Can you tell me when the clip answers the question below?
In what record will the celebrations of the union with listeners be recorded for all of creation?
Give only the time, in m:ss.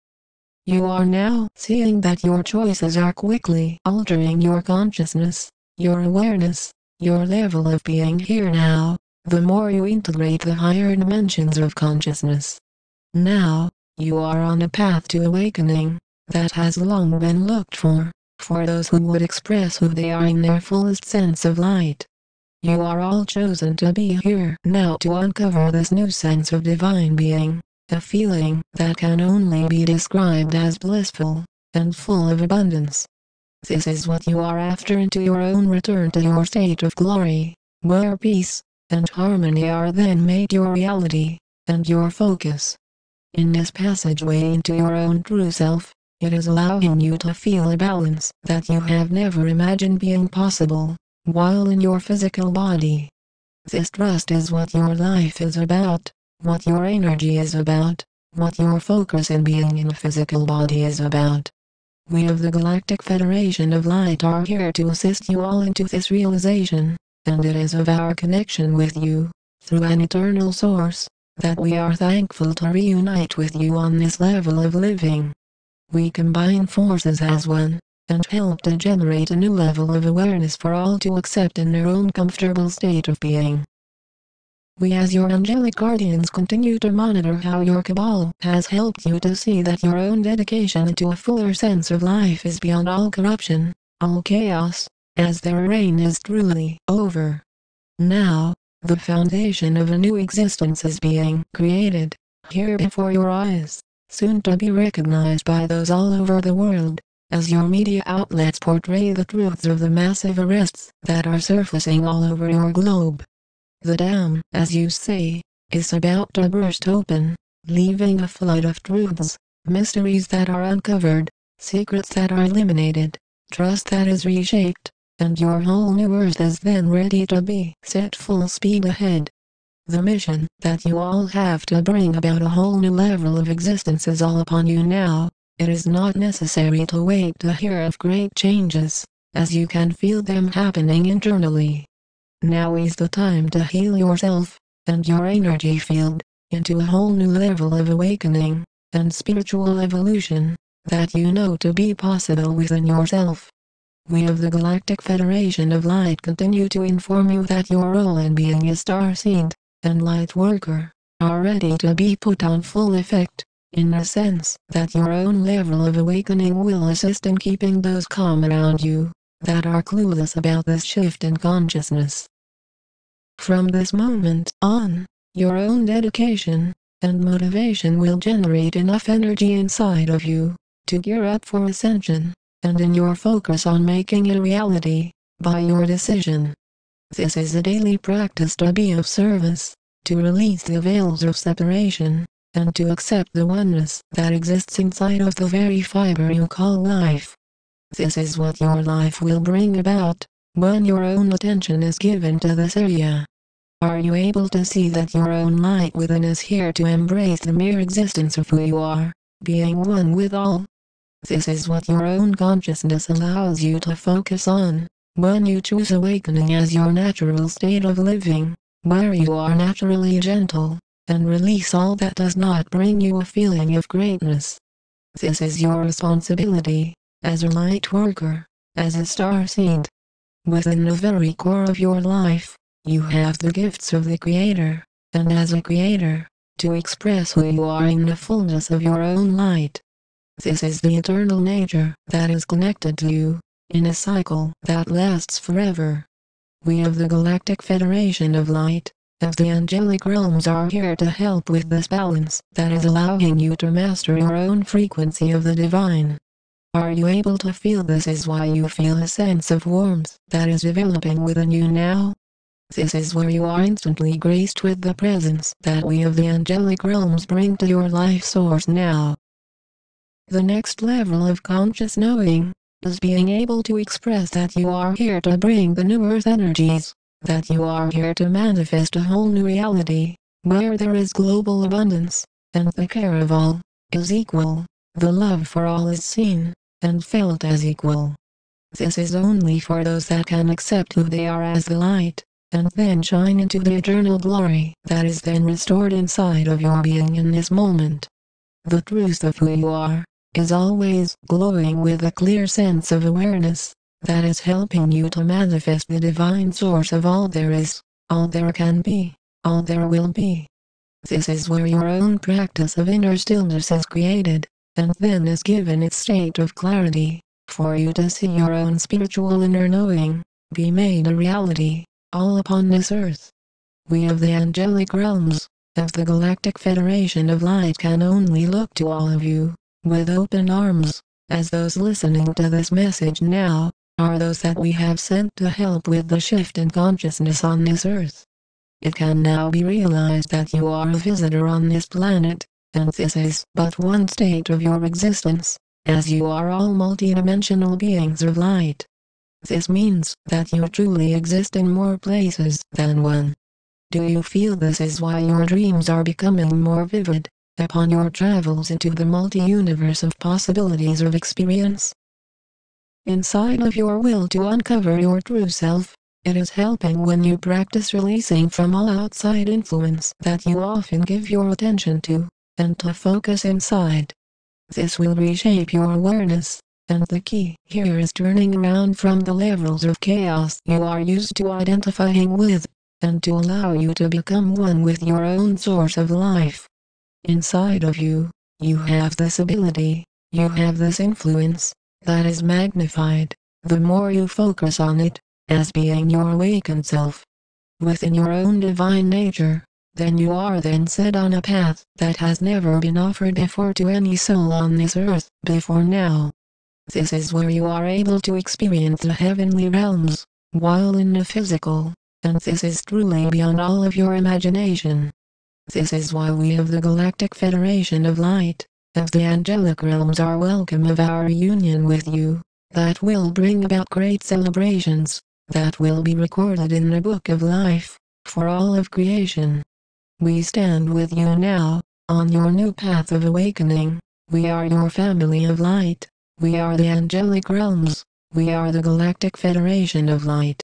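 7:07.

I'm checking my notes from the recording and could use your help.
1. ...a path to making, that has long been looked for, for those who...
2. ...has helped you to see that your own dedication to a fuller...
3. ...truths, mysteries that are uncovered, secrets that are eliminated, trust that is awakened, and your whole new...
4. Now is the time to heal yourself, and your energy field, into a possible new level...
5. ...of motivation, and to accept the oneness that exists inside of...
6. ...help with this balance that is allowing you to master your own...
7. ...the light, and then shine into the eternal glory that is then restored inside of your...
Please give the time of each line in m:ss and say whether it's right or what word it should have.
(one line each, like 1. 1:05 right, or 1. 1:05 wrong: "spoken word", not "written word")
1. 0:14 wrong: "awakening", not "making"
2. 1:28 right
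3. 1:58 wrong: "reshaped", not "awakened"
4. 2:22 wrong: "whole", not "possible"
5. 3:11 wrong: "separation", not "motivation"
6. 4:11 right
7. 4:51 right.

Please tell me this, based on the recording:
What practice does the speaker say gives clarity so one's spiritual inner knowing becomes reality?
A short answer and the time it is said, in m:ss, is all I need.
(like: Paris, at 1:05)
Inner stillness, at 5:12.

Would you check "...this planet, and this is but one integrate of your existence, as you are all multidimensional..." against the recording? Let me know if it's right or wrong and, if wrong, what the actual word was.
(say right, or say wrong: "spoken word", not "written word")
wrong: "state", not "integrate".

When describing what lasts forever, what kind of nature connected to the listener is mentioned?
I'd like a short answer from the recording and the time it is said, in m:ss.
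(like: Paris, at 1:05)
Eternal nature, at 4:00.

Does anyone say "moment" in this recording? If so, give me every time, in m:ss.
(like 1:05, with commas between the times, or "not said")
2:53, 4:57.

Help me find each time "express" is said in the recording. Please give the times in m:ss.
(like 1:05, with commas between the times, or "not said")
0:19, 3:56, 4:33.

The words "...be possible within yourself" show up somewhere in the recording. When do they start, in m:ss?
2:31.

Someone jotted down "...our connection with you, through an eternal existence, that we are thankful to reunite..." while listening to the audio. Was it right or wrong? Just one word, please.
wrong.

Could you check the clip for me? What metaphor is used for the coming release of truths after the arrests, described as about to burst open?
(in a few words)
The dam.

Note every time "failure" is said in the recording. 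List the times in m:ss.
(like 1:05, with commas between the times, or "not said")
not said.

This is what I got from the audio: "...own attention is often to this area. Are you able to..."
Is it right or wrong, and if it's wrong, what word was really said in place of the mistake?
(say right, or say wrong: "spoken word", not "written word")
wrong: "given", not "often".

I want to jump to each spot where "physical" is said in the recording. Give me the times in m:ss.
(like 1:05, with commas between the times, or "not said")
0:51, 0:59, 6:51.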